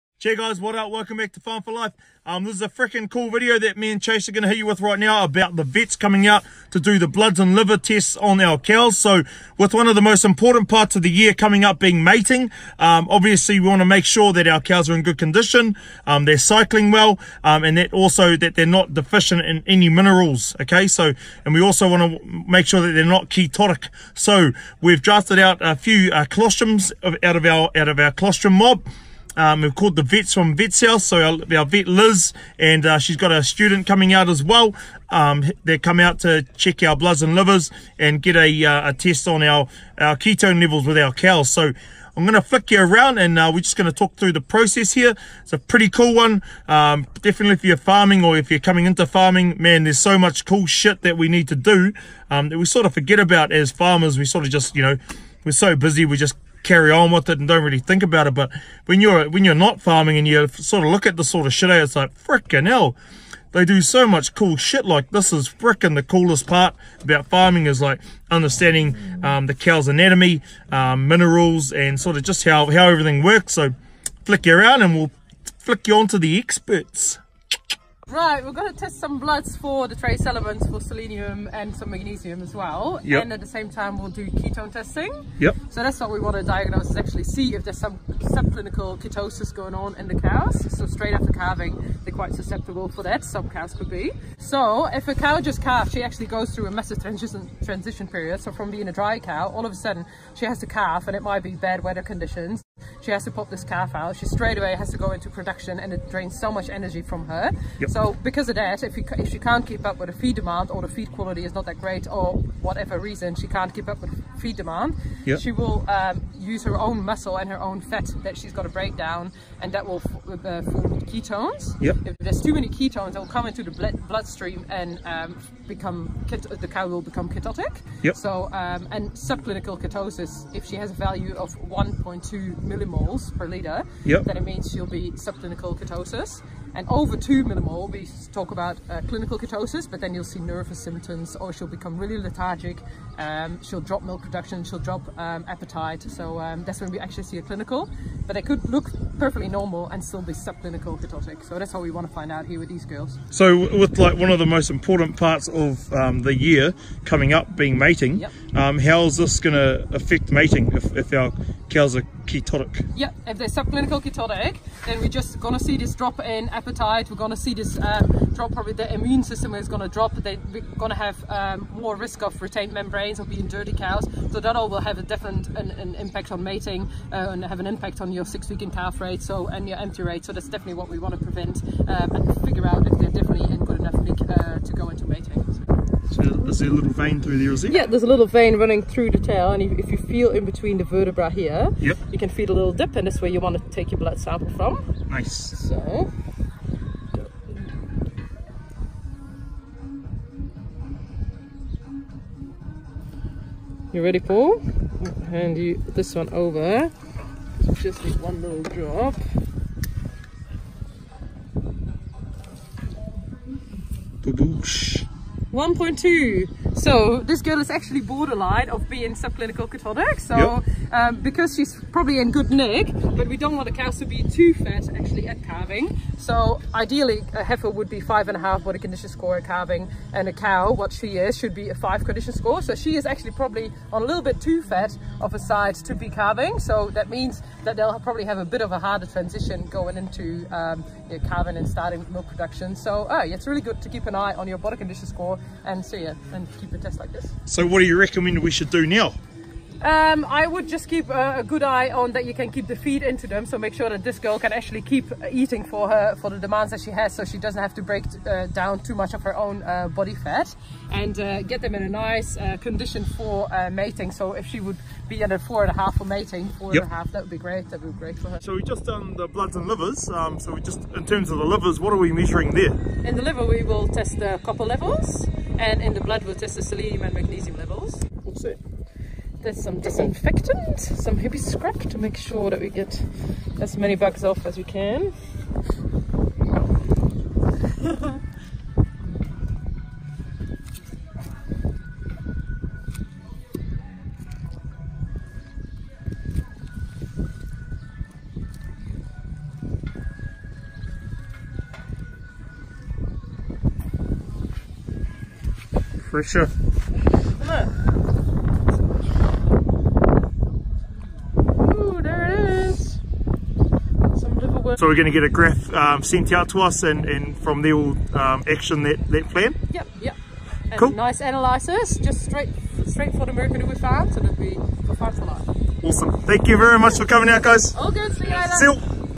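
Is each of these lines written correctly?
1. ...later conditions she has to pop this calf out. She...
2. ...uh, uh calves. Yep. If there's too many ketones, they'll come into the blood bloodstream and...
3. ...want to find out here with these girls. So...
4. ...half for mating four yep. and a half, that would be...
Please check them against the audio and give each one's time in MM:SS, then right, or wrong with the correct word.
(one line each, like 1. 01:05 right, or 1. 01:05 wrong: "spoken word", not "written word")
1. 01:41 wrong: "weather", not "later"
2. 02:00 wrong: "ketones", not "calves"
3. 02:31 right
4. 04:25 right.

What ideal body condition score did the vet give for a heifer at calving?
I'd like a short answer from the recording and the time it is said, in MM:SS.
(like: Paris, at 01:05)
5.5, at 03:47.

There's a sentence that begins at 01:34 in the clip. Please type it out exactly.
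So if a cow just calves, she actually goes through a massive transition, transition period.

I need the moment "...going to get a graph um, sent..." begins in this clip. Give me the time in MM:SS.
05:14.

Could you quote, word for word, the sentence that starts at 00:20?
Okay, so, and we also want to make sure that they're not ketotic.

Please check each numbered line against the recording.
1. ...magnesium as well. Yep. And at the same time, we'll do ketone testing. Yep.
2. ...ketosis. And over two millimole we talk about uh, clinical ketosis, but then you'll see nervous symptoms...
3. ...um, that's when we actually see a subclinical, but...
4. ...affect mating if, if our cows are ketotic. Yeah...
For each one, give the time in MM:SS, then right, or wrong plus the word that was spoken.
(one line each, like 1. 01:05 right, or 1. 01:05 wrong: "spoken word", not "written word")
1. 01:21 right
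2. 02:15 right
3. 02:26 wrong: "clinical", not "subclinical"
4. 02:39 right.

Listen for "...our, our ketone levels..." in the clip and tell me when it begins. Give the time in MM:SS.
00:39.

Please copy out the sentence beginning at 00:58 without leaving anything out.
But when you're when you're not farming and you sort of look at the sort of shit, it's like freaking hell.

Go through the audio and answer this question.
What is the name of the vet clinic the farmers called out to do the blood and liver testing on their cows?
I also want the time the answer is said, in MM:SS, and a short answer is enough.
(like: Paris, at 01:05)
Vets House, at 00:30.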